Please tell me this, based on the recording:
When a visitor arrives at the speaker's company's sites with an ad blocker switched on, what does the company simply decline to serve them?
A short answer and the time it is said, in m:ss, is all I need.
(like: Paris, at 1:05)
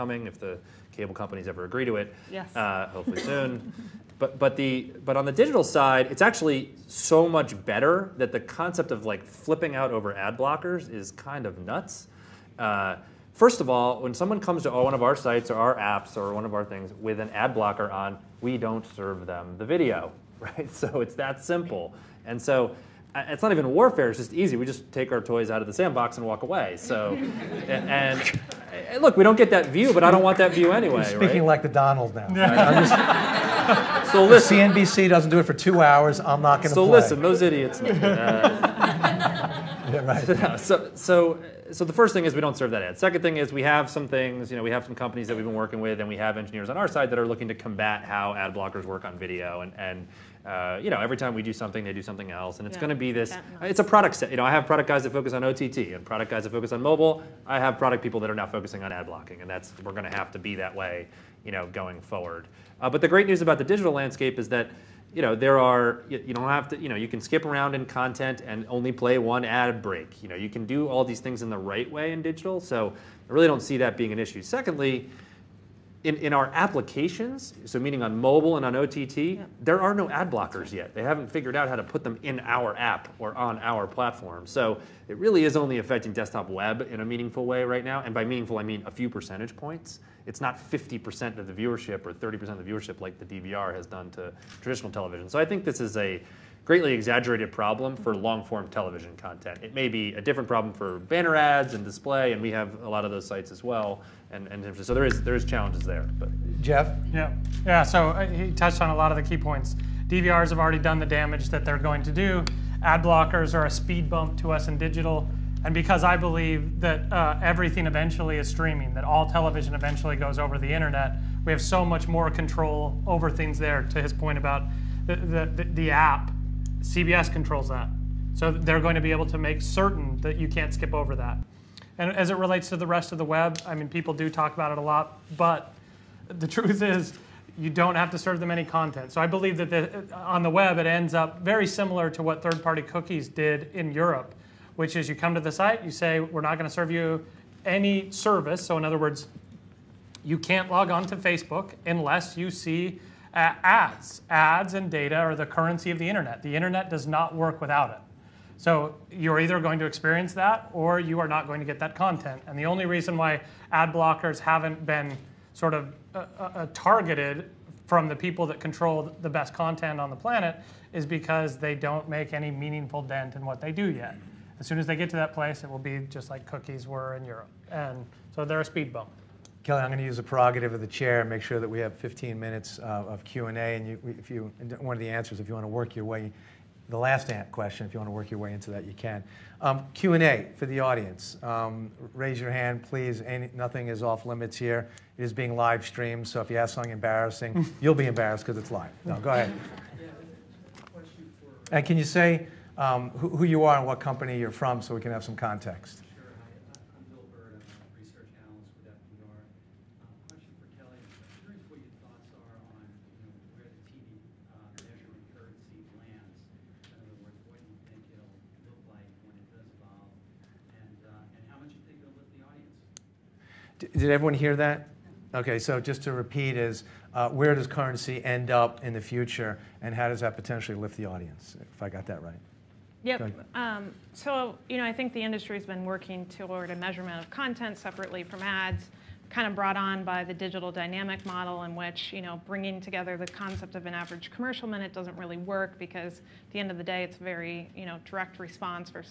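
the video, at 0:19.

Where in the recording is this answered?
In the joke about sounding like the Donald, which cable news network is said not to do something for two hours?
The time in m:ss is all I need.
0:34.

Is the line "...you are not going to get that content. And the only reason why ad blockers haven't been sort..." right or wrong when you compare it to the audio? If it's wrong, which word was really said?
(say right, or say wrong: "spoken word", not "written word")
right.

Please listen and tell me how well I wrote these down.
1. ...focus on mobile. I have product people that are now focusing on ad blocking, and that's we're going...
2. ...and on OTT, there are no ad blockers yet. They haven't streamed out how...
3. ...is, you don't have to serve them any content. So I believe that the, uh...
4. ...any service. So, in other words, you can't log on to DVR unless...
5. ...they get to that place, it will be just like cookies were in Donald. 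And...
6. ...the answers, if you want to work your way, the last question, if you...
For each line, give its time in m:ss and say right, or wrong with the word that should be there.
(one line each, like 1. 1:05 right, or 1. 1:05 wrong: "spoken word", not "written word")
1. 0:56 right
2. 1:18 wrong: "figured", not "streamed"
3. 2:16 right
4. 2:27 wrong: "Facebook", not "DVR"
5. 2:54 wrong: "Europe", not "Donald"
6. 3:04 right.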